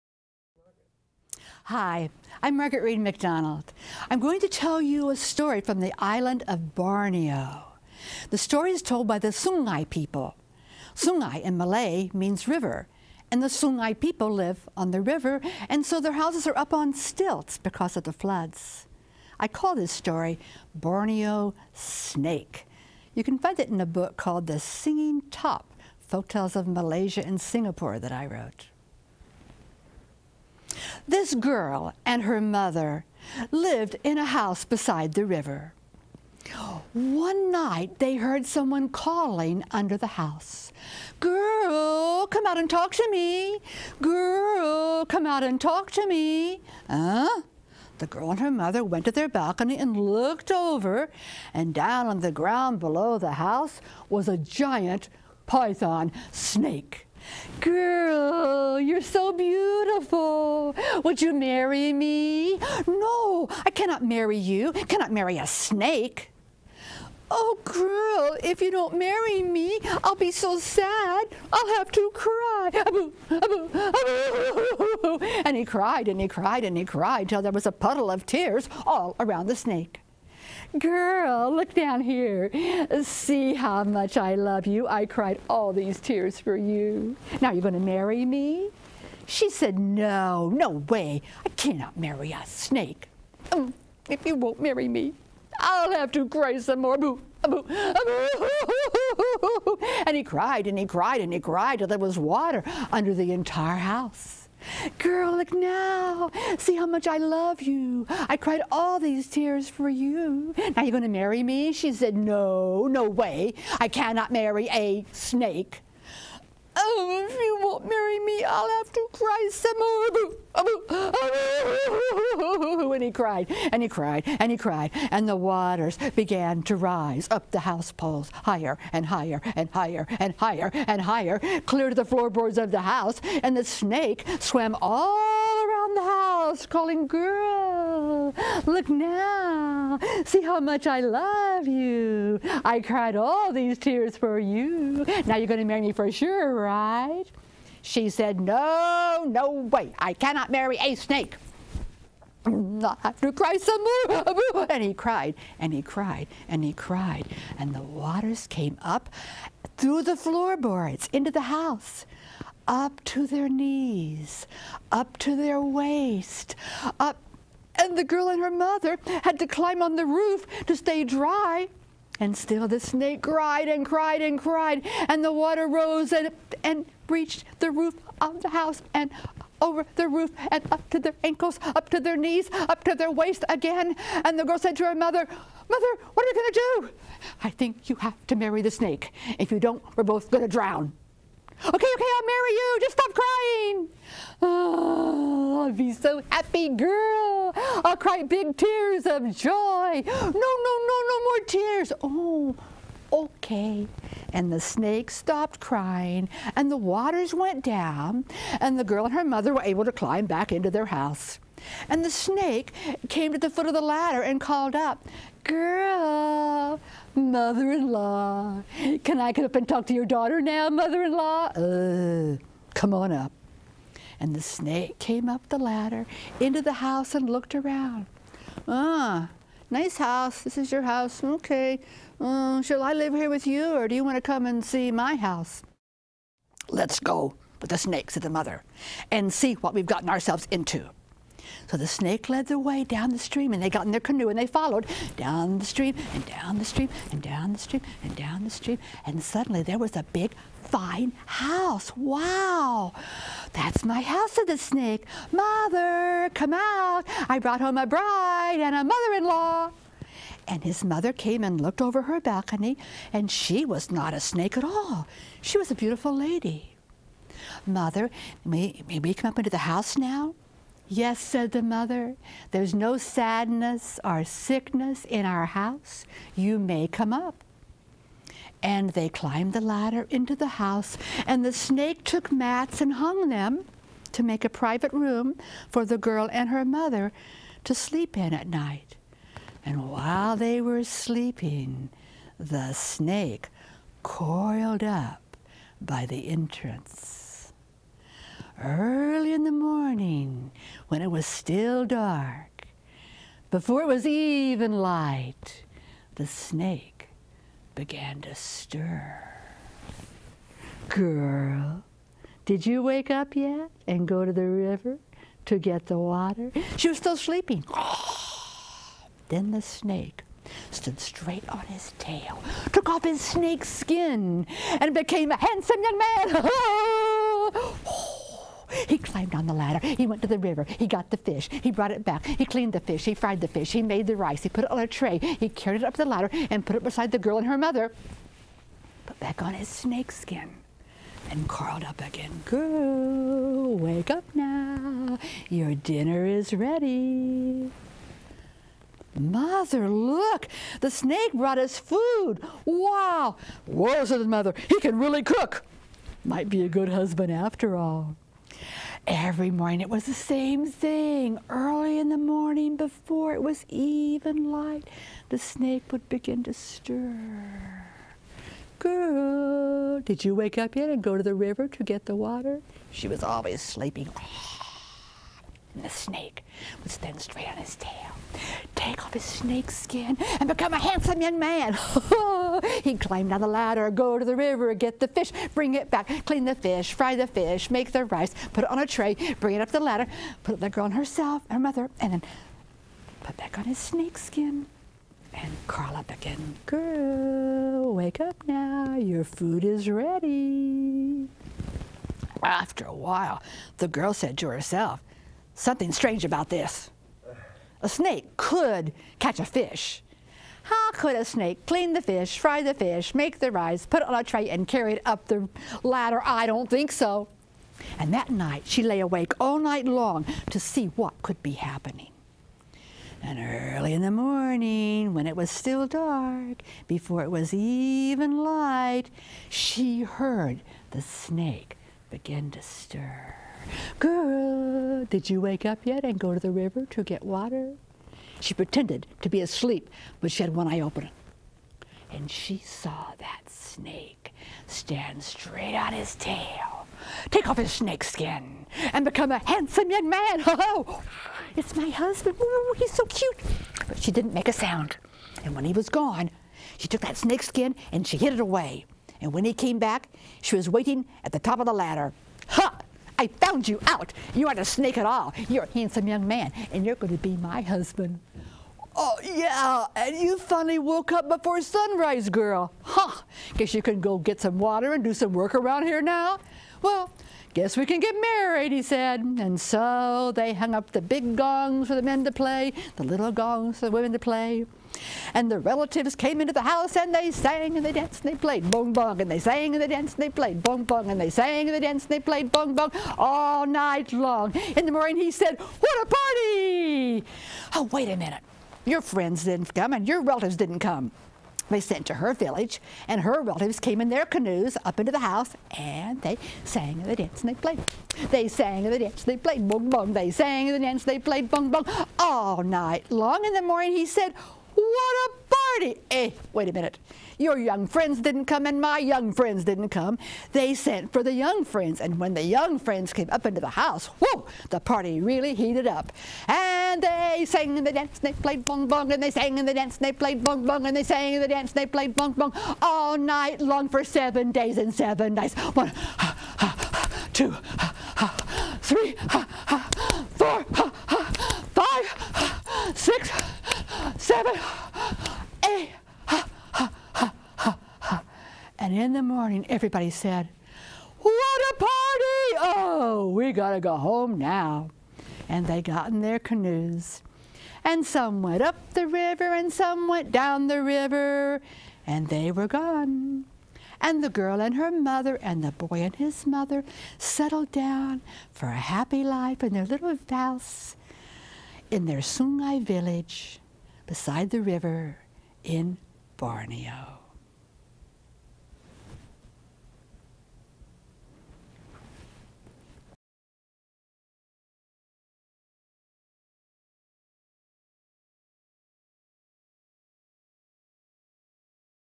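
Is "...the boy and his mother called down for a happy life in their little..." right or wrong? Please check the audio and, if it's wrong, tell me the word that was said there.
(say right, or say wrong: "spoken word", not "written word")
wrong: "settled", not "called".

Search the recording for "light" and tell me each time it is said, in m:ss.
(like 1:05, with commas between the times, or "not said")
5:04, 6:04, 7:08.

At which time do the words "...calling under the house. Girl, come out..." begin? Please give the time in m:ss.
0:38.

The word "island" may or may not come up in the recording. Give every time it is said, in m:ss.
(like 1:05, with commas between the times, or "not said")
0:05.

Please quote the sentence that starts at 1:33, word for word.
Um, if you won't marry me, I'll have to cry some more.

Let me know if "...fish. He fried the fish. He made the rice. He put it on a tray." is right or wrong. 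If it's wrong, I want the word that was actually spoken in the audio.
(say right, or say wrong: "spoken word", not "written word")
right.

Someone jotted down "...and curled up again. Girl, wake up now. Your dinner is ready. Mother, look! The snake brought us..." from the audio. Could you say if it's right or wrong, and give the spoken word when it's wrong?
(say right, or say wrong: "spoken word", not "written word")
right.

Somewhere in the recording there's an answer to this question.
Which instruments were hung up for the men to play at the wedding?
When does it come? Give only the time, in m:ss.
8:01.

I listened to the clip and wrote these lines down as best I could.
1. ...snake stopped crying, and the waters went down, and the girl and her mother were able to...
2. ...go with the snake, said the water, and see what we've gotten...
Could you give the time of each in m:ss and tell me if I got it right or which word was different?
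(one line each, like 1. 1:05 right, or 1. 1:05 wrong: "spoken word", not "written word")
1. 3:24 right
2. 3:56 wrong: "mother", not "water".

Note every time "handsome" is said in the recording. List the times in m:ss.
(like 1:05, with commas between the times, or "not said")
5:25, 6:20, 7:29, 7:45.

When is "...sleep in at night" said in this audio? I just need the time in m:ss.
4:47.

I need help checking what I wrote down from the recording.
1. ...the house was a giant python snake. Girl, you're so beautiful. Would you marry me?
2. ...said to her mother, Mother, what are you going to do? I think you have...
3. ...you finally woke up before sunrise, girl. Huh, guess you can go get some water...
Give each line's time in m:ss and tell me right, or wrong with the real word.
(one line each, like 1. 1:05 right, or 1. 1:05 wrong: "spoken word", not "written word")
1. 0:53 right
2. 3:04 right
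3. 7:50 right.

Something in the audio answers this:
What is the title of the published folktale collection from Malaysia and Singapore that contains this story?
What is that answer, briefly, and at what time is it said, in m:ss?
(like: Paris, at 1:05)
The Singing Top, at 0:24.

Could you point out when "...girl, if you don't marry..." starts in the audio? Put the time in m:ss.
1:07.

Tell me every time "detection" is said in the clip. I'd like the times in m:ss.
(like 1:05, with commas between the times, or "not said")
not said.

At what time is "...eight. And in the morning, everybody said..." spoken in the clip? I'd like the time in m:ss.
9:05.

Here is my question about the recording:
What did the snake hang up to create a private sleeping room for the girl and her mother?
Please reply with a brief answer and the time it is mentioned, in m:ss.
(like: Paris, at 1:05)
mats, at 4:42.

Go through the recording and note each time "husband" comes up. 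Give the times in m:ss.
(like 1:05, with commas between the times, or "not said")
5:56, 7:31, 7:47.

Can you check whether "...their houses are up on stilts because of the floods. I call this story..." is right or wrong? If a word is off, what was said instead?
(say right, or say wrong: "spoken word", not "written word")
right.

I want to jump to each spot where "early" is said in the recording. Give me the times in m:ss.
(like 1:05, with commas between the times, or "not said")
4:58, 6:01, 7:03.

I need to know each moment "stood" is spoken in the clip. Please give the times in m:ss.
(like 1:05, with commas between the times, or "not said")
5:20.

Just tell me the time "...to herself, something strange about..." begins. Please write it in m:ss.
6:44.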